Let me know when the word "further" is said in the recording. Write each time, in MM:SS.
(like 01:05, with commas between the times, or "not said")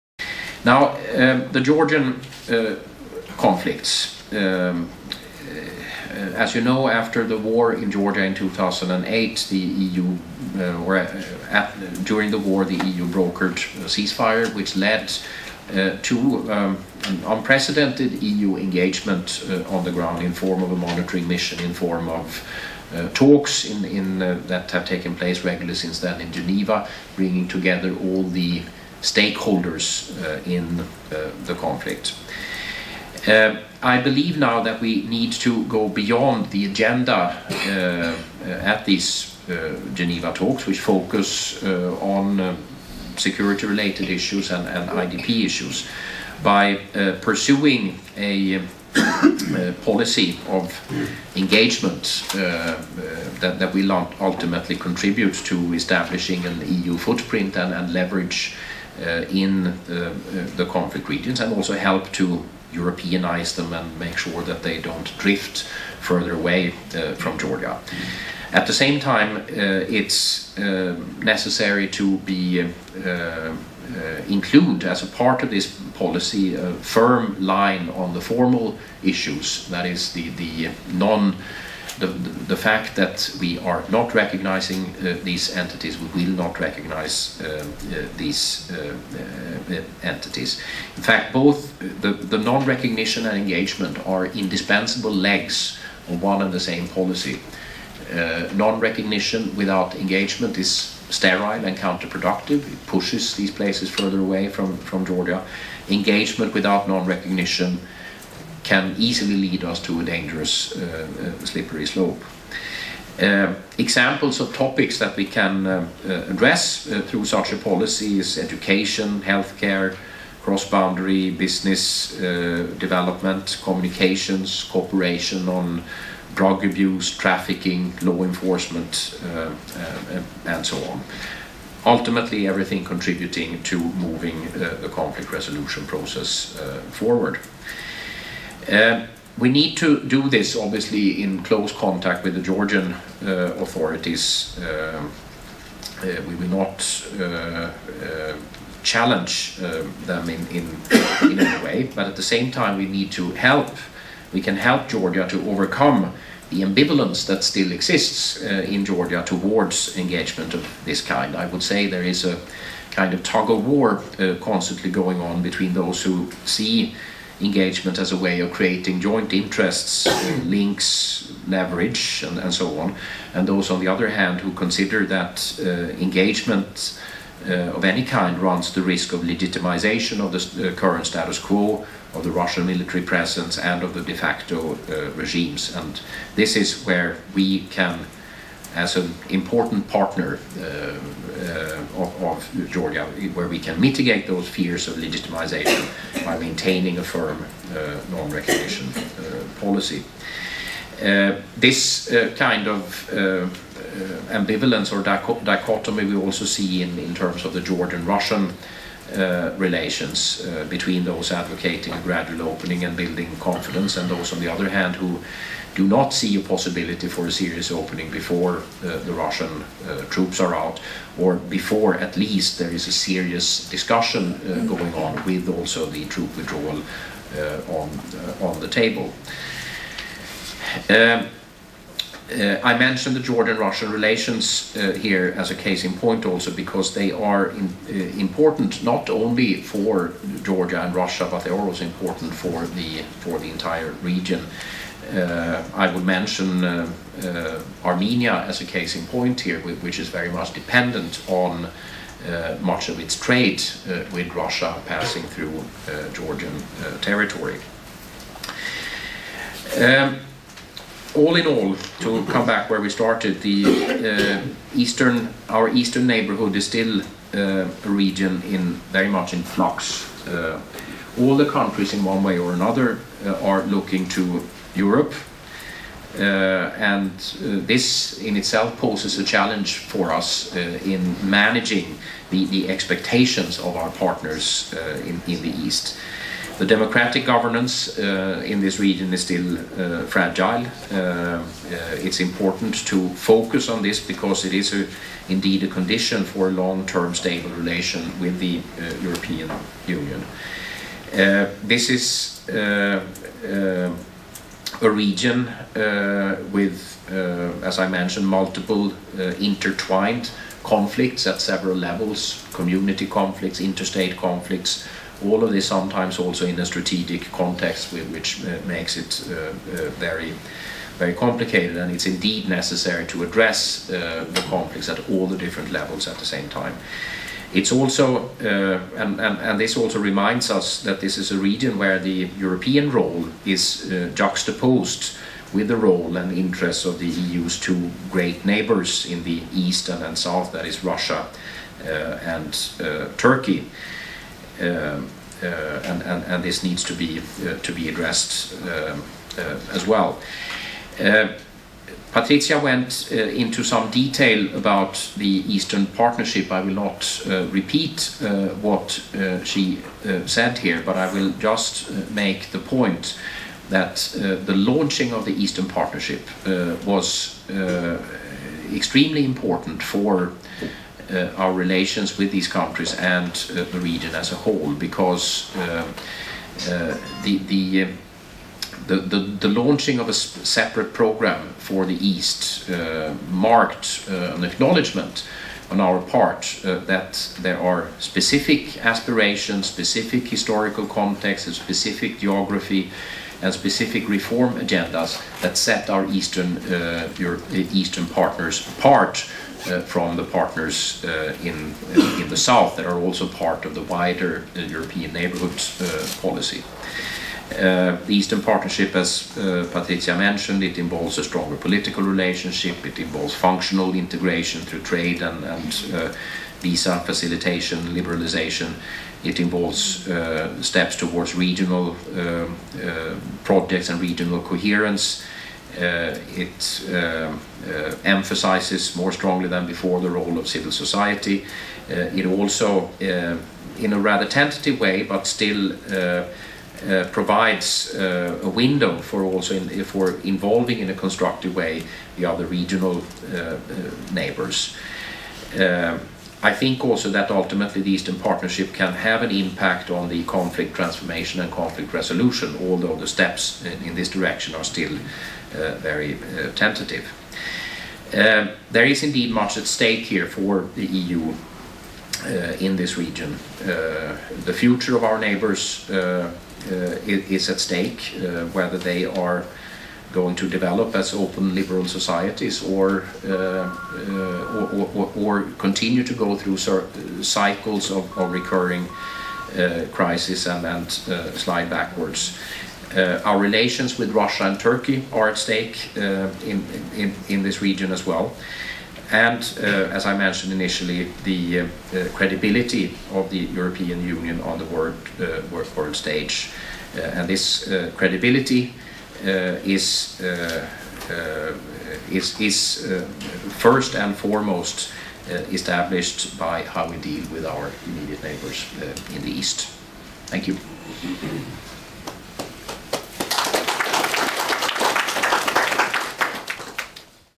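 01:06, 01:43.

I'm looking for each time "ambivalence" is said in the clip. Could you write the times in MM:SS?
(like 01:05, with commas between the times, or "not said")
02:36, 03:24.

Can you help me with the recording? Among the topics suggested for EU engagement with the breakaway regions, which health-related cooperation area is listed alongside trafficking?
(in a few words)
drug abuse.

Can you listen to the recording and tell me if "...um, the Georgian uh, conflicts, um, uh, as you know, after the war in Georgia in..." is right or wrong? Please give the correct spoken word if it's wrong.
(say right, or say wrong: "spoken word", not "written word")
right.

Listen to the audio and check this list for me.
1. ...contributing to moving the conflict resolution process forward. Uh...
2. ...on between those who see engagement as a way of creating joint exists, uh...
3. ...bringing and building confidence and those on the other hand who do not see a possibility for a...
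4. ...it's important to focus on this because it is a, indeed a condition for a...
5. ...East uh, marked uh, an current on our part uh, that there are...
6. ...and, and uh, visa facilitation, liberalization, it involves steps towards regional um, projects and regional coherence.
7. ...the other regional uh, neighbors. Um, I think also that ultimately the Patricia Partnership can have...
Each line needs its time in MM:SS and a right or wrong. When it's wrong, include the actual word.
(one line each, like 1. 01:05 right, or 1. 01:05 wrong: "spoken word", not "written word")
1. 02:12 right
2. 02:45 wrong: "interests", not "exists"
3. 03:32 wrong: "opening", not "bringing"
4. 04:52 right
5. 06:21 wrong: "acknowledgement", not "current"
6. 06:55 right
7. 07:22 wrong: "Eastern", not "Patricia".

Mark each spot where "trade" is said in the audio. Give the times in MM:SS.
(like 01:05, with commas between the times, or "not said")
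04:13, 06:54.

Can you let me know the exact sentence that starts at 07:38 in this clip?
Um, there is indeed much at stake here for the EU uh, in this region.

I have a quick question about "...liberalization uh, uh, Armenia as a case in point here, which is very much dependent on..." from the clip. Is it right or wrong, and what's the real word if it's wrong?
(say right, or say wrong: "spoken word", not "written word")
wrong: "mention", not "liberalization".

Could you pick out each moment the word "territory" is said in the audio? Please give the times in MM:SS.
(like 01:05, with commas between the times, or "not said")
04:17.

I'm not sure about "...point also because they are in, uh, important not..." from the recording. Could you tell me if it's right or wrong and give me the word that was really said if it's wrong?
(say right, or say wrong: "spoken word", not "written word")
right.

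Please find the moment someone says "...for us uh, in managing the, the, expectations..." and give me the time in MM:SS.
04:39.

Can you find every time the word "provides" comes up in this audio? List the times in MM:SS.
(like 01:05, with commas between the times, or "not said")
07:17.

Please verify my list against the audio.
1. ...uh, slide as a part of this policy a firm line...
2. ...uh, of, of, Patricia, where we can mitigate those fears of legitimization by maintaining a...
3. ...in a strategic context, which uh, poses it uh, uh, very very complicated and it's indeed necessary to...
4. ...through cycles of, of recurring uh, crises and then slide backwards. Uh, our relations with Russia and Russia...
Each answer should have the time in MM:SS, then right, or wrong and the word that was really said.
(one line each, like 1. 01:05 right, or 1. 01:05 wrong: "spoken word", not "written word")
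1. 01:13 wrong: "include", not "slide"
2. 03:10 wrong: "Georgia", not "Patricia"
3. 05:16 wrong: "makes", not "poses"
4. 07:56 wrong: "Turkey", not "Russia".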